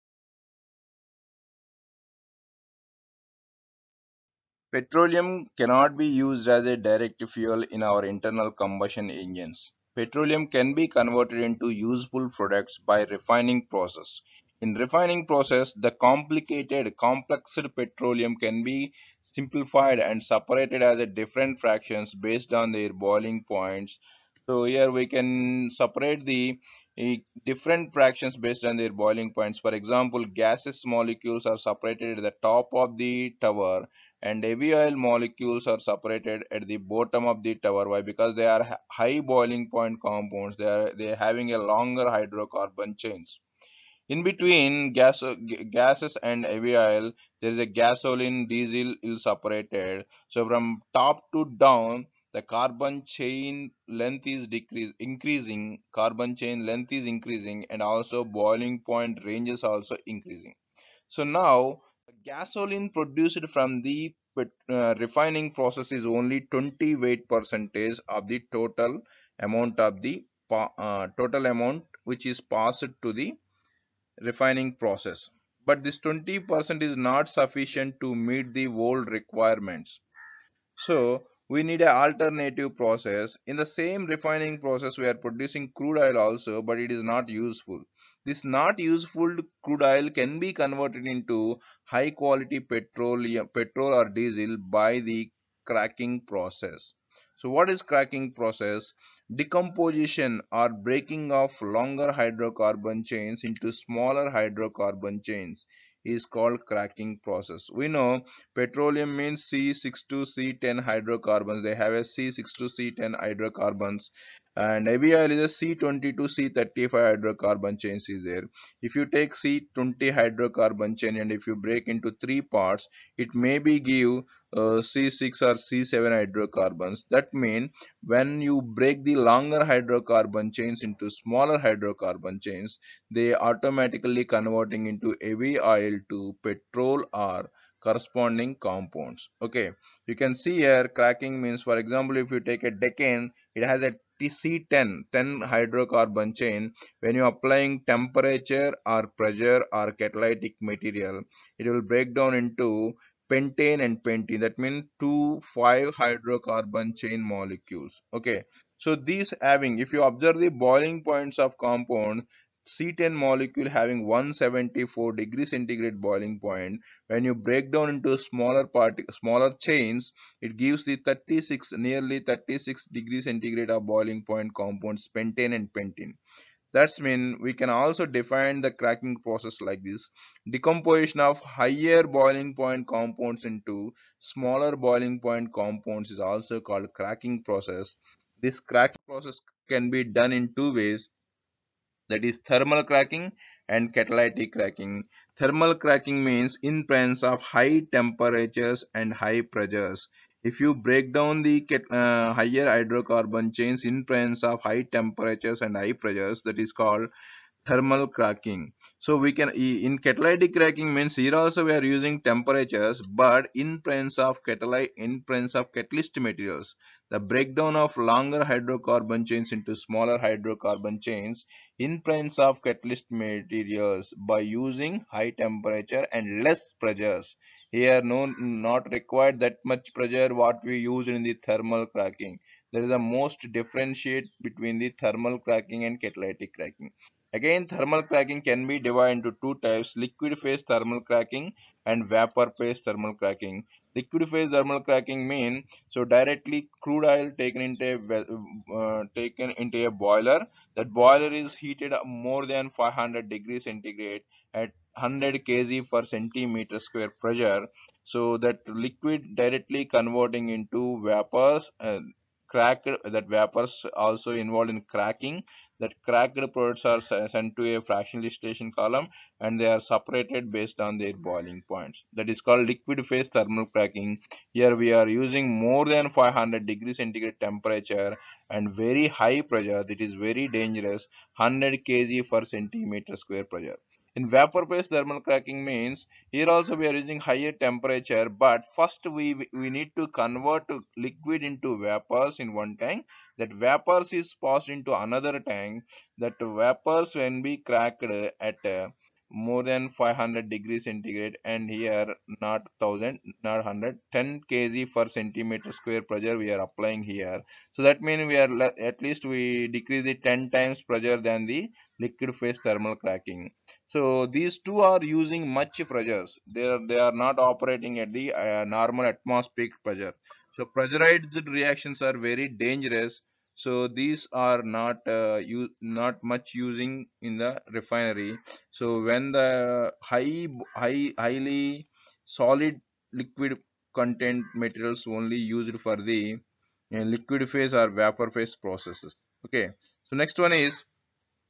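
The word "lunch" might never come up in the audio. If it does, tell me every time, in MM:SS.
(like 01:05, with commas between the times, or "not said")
not said.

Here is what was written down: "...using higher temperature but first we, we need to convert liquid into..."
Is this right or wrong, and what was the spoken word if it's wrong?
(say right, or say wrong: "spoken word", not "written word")
right.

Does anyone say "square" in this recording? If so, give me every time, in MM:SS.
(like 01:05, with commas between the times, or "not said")
04:16, 04:43, 05:05.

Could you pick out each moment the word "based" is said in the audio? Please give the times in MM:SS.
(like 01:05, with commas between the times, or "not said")
00:22, 00:28, 04:30, 04:44.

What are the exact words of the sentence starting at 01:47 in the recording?
We know petroleum means C6 to C10 hydrocarbons.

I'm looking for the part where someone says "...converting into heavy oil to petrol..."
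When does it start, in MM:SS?
02:14.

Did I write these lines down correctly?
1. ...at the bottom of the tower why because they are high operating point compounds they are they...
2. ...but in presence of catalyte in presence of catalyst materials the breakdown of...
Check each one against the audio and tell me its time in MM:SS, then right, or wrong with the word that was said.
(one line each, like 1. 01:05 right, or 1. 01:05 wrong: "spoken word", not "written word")
1. 00:36 wrong: "boiling", not "operating"
2. 03:33 right.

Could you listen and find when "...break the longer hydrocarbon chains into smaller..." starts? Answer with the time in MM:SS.
02:08.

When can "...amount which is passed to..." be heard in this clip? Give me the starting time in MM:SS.
01:11.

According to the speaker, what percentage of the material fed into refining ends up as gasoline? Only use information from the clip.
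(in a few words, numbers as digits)
28%.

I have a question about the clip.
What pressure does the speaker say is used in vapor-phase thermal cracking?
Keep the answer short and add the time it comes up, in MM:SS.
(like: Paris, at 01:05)
10 kg per cm², at 05:04.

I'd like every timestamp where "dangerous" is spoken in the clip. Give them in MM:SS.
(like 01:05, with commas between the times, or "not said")
04:40, 05:22.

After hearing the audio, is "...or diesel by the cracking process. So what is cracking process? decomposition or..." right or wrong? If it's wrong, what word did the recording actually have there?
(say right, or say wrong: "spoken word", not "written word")
right.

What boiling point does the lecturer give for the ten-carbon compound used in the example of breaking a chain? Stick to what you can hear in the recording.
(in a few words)
174 degrees centigrade.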